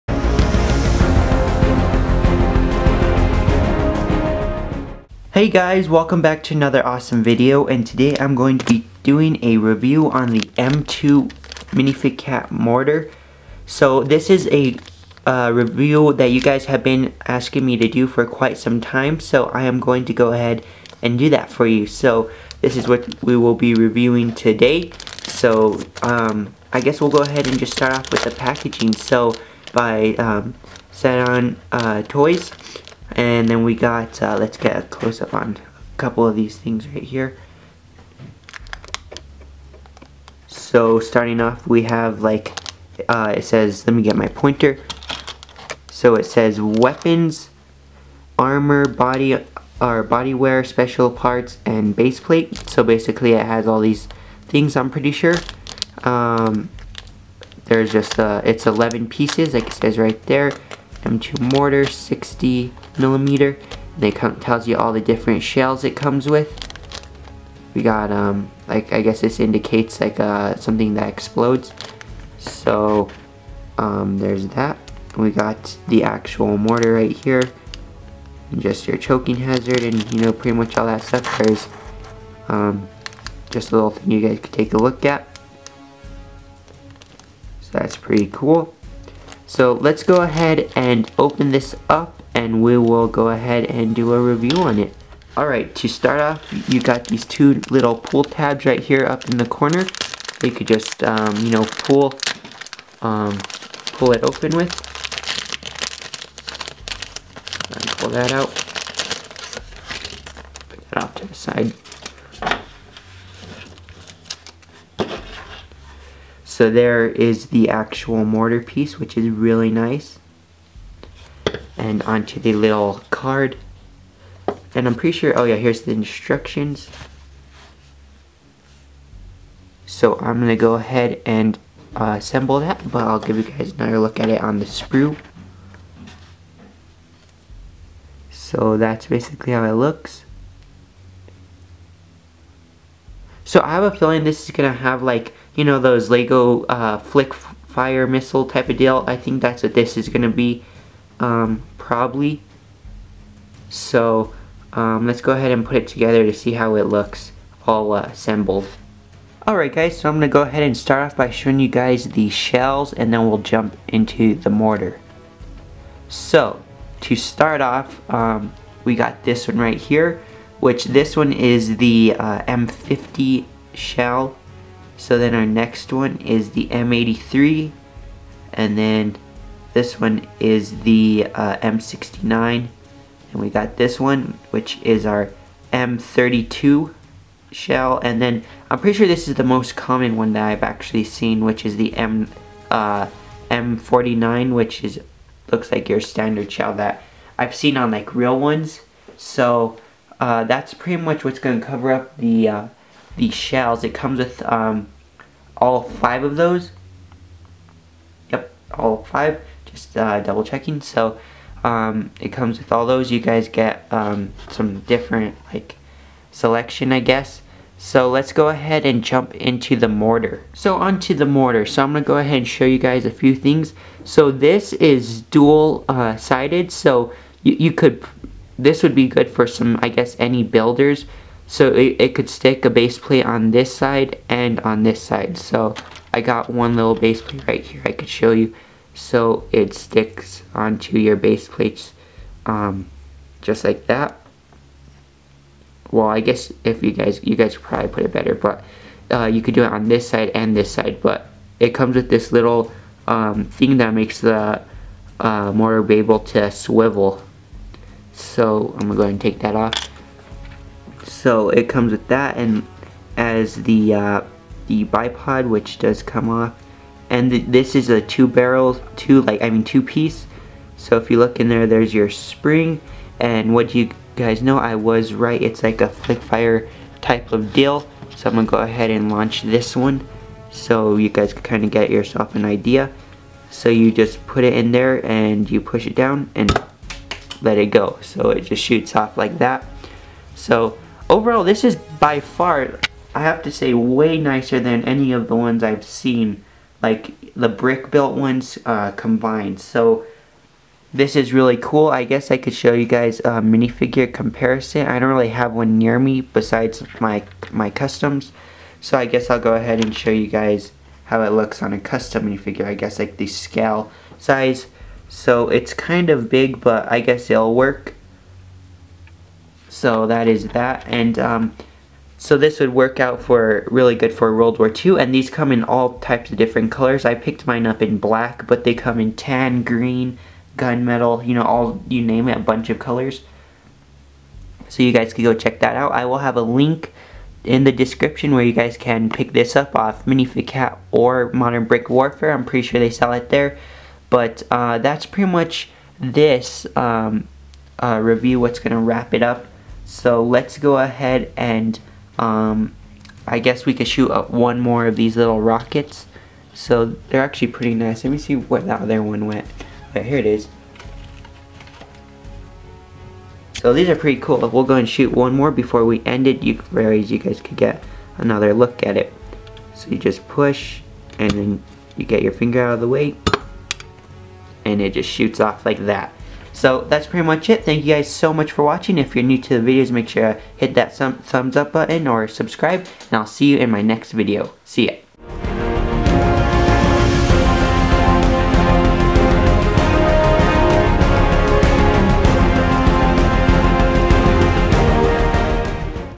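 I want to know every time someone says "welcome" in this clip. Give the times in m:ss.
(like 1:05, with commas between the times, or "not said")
0:05.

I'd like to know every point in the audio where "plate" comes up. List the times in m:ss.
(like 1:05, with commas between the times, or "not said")
0:52, 3:52, 3:57, 4:01.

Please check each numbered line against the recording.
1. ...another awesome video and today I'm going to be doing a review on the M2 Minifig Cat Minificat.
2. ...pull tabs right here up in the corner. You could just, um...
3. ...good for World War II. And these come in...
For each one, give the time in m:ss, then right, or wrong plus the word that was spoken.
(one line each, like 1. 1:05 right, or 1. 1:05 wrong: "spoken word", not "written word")
1. 0:06 wrong: "Mortar", not "Minificat"
2. 1:37 right
3. 5:23 right.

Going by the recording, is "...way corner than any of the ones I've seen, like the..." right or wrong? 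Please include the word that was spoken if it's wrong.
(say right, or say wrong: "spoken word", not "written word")
wrong: "nicer", not "corner".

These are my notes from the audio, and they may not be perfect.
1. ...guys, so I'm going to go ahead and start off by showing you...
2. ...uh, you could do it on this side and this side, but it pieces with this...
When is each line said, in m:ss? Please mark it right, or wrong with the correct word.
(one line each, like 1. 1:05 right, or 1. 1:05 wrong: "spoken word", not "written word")
1. 2:39 right
2. 4:09 wrong: "comes", not "pieces".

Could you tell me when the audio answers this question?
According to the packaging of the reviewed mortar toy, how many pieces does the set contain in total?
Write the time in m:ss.
0:58.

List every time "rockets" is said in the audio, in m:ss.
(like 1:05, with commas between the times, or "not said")
5:55.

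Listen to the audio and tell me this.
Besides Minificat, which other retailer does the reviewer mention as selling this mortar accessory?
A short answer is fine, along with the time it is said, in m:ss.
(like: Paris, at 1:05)
Modern Brick Warfare, at 5:41.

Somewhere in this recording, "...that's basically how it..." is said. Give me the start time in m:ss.
2:18.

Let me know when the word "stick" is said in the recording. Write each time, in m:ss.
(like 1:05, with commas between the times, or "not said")
3:52, 3:59.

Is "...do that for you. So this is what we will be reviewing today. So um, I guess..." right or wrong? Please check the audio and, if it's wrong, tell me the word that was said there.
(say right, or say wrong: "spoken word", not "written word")
right.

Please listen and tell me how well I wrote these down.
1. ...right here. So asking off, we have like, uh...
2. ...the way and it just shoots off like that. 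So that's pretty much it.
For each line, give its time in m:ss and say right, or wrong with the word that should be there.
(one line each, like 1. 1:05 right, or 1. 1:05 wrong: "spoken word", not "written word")
1. 0:36 wrong: "starting", not "asking"
2. 6:12 right.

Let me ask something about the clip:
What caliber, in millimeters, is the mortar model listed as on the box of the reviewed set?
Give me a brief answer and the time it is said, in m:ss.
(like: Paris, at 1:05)
60 millimeter, at 1:01.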